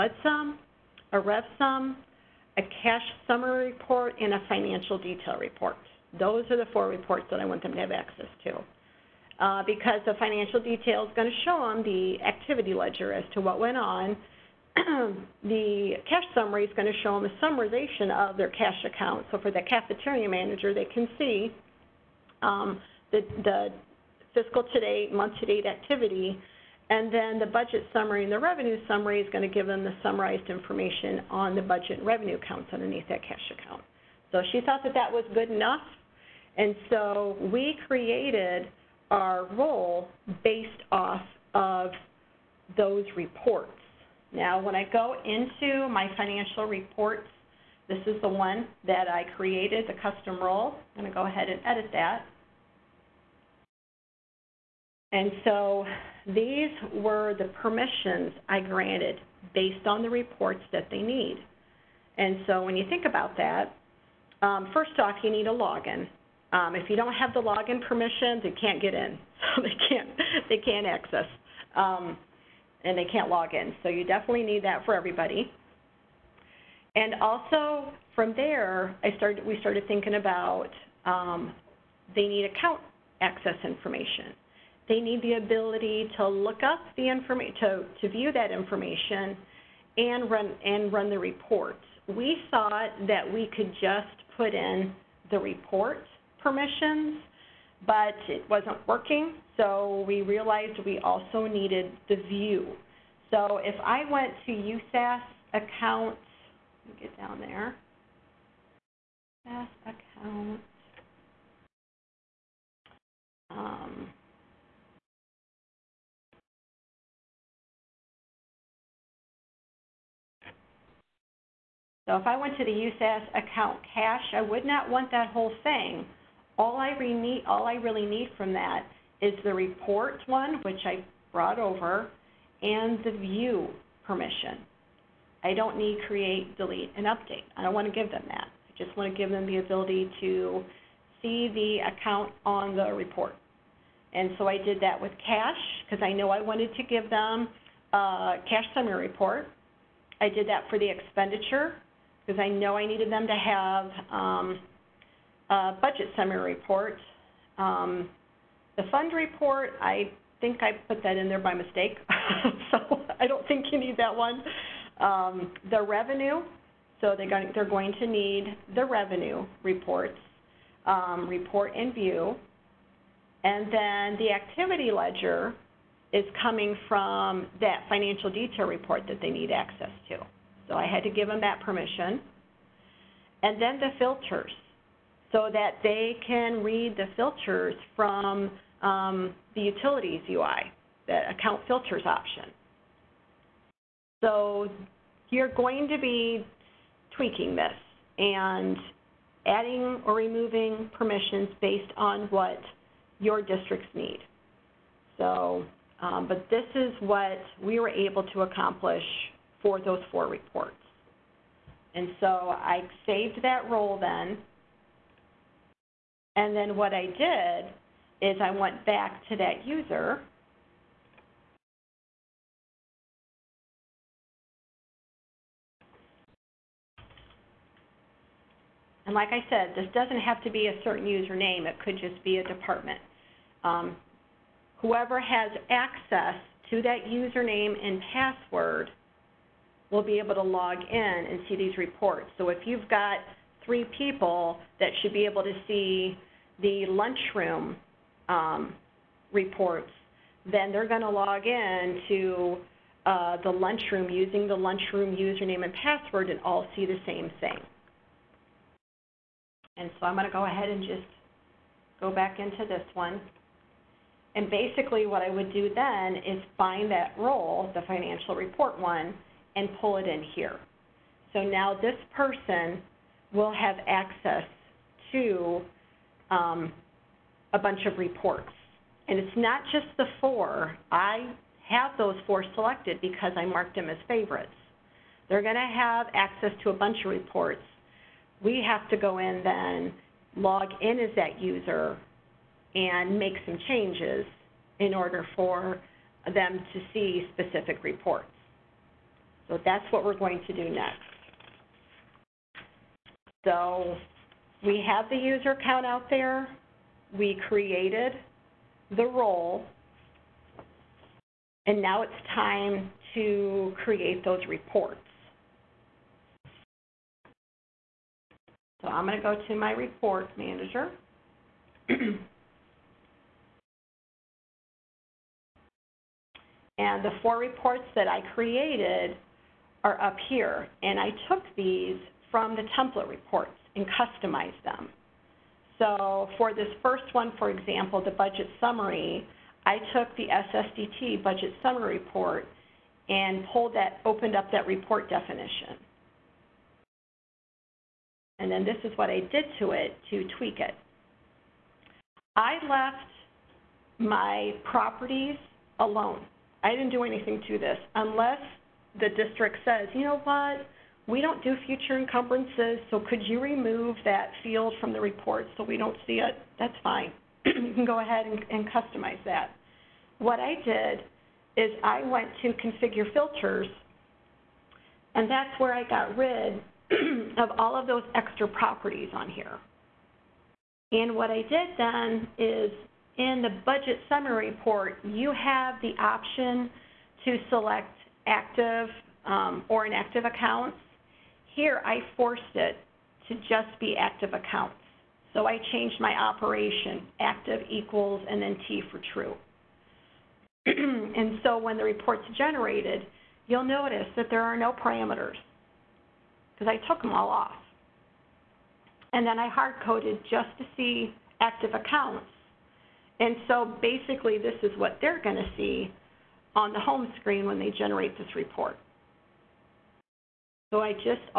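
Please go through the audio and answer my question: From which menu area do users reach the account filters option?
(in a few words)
Utilities UI.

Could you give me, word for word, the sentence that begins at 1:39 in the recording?
So we realized we also needed the view.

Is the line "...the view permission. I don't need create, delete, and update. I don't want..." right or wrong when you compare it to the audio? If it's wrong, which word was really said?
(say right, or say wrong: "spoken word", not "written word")
right.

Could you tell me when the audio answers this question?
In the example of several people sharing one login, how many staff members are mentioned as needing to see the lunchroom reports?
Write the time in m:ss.
4:03.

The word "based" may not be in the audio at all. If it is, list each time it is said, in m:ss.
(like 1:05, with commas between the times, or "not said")
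0:40, 0:59, 3:21.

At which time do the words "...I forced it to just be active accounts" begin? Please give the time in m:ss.
6:31.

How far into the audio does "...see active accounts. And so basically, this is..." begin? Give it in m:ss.
6:50.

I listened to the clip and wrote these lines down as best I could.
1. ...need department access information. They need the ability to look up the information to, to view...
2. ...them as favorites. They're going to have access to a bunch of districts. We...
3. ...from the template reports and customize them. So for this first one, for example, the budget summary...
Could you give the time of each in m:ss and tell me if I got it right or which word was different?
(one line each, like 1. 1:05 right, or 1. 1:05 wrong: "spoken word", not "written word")
1. 1:22 wrong: "account", not "department"
2. 4:43 wrong: "reports", not "districts"
3. 5:32 right.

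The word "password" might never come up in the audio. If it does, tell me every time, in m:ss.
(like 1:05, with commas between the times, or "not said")
3:58, 4:15.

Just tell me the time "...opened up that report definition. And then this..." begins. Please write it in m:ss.
5:44.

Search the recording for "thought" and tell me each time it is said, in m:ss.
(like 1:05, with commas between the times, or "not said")
0:34, 1:32.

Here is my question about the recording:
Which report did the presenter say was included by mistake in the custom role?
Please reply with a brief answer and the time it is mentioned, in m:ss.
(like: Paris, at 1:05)
Fund report, at 2:38.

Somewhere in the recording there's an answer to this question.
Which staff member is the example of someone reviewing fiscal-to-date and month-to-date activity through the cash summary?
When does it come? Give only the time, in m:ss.
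0:19.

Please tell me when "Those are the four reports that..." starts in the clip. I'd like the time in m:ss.
0:06.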